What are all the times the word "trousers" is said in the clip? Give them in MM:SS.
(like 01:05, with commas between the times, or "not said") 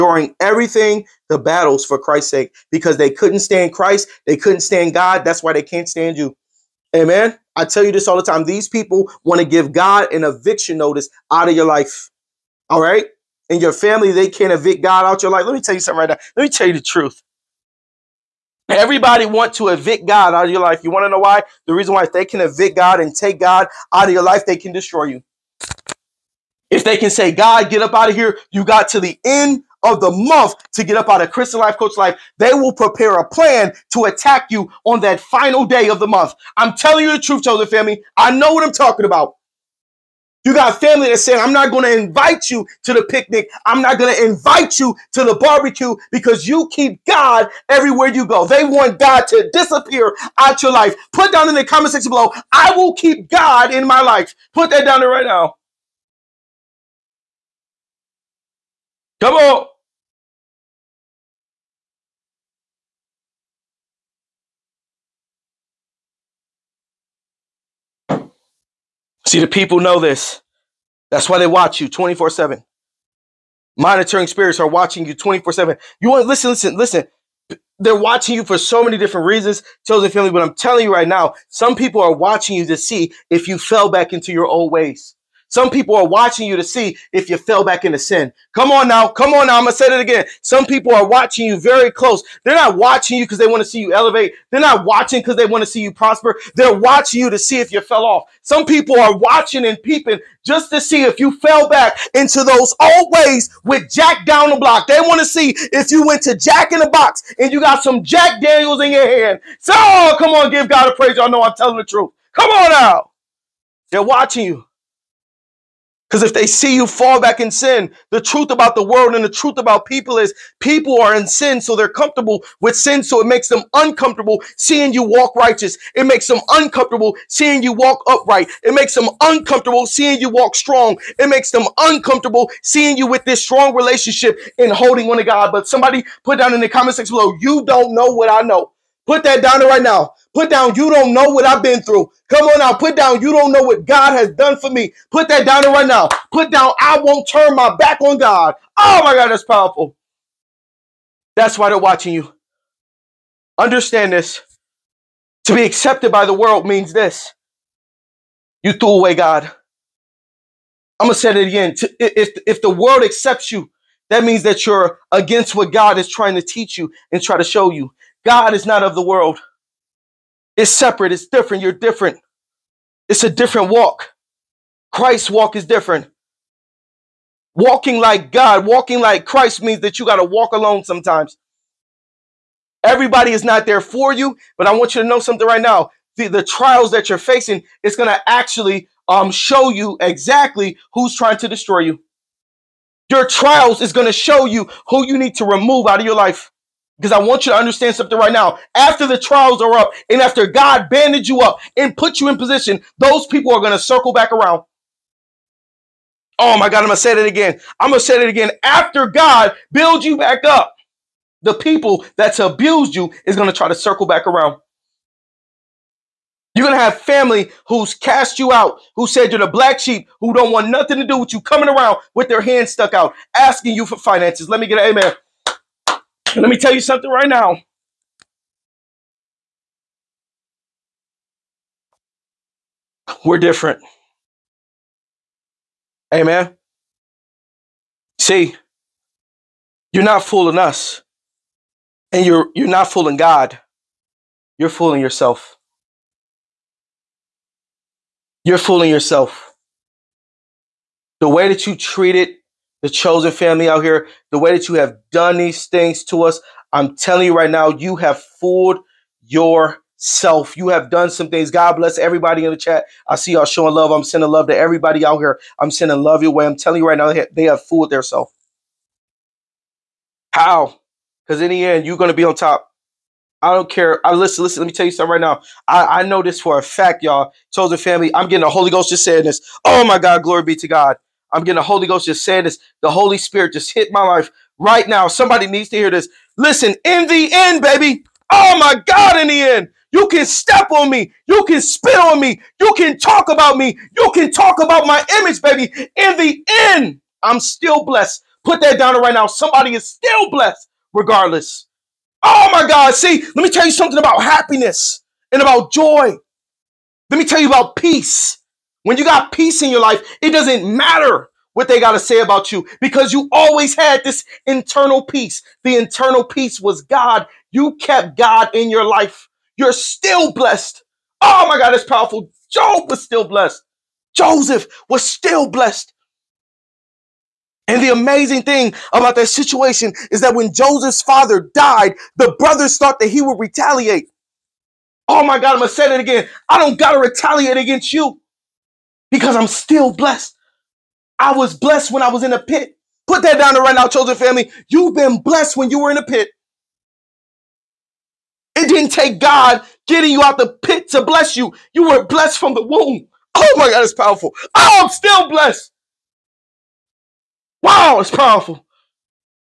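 not said.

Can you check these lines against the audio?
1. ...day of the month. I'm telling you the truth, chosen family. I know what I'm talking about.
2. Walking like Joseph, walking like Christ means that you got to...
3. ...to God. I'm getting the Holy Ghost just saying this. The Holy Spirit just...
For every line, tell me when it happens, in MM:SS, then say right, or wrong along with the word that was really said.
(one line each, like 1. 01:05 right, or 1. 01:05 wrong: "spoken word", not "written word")
1. 00:35 right
2. 02:57 wrong: "God", not "Joseph"
3. 04:40 right.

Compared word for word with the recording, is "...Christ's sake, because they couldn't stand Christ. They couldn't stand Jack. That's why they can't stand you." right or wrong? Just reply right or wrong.
wrong.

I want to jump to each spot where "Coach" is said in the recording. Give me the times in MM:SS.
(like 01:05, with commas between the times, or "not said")
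00:31.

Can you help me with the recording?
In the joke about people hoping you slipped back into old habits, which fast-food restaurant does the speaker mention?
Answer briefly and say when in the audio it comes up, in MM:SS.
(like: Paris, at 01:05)
Jack in the Box, at 01:46.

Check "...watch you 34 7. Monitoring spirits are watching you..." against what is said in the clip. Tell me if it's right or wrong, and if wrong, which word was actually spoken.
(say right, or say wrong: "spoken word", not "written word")
wrong: "24", not "34".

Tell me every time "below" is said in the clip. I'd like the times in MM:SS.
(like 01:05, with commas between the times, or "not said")
00:52, 02:17.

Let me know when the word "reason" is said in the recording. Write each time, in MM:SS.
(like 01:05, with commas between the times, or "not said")
00:21, 01:19.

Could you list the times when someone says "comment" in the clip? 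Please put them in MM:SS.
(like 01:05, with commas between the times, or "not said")
00:51, 02:16.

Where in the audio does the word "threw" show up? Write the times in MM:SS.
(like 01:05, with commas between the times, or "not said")
02:38.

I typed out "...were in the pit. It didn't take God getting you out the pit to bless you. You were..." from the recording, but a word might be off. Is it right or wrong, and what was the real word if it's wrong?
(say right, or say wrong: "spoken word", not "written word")
right.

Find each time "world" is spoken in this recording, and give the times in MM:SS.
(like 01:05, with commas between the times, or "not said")
01:58, 02:36, 02:42, 02:49.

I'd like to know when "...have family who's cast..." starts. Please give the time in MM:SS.
03:36.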